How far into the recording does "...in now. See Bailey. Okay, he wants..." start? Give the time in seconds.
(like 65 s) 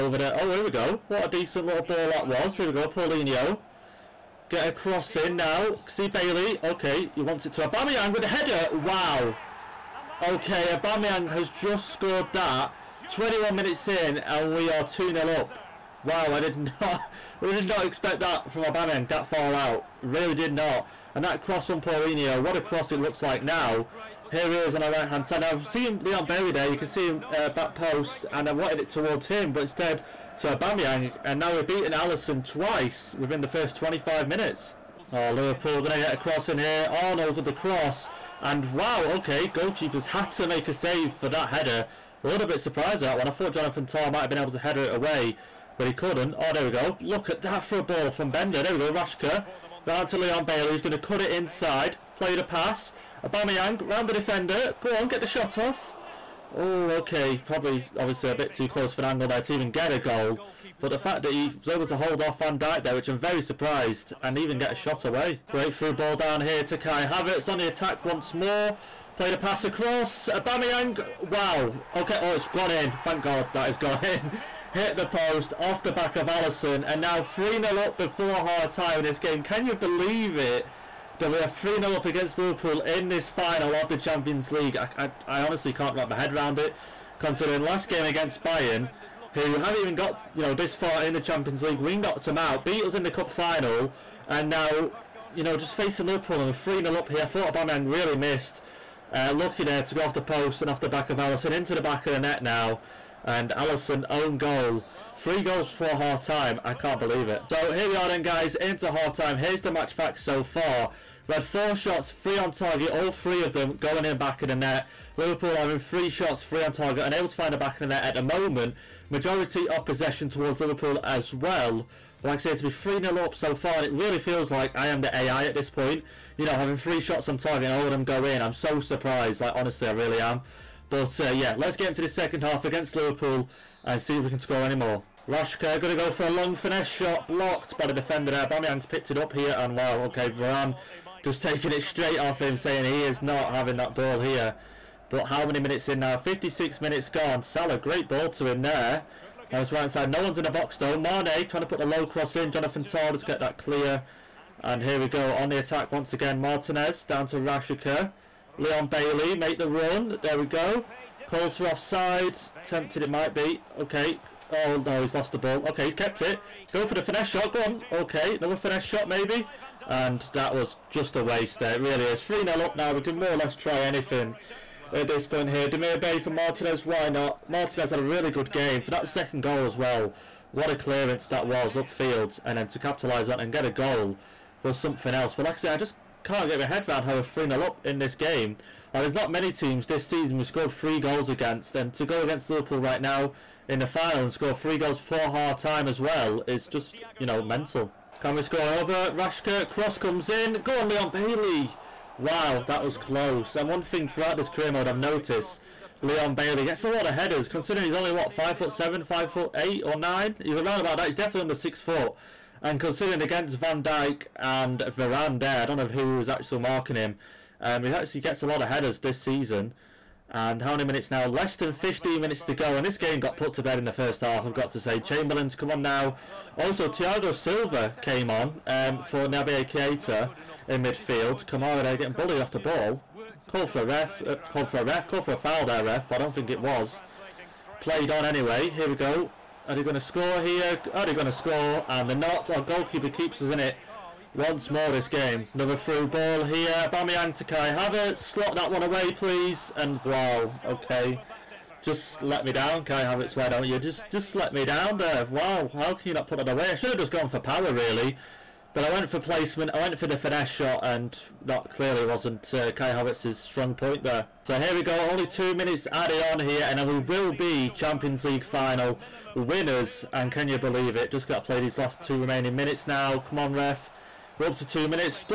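5 s.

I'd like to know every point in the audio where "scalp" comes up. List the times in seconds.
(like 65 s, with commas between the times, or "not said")
not said.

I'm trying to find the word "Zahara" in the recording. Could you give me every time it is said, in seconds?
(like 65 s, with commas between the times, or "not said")
not said.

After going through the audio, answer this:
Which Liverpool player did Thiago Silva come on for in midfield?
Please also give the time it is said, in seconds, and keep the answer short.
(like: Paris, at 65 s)
Naby Keita, at 229 s.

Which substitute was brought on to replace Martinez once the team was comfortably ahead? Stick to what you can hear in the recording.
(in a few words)
Demirbay.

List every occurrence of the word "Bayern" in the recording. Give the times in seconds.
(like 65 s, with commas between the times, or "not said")
88 s.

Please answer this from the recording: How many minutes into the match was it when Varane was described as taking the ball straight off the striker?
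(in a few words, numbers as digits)
56.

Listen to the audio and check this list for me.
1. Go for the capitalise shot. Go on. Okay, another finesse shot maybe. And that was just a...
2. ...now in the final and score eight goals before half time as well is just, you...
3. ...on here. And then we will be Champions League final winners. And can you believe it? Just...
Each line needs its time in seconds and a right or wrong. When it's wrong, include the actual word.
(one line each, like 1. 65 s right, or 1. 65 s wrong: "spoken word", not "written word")
1. 166 s wrong: "finesse", not "capitalise"
2. 192 s wrong: "three", not "eight"
3. 266 s right.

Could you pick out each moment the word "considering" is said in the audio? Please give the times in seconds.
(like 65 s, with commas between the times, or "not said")
87 s, 207 s, 212 s.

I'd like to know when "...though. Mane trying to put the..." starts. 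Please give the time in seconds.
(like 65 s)
150 s.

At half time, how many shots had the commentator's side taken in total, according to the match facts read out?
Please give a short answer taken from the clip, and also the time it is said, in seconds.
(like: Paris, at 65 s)
4, at 111 s.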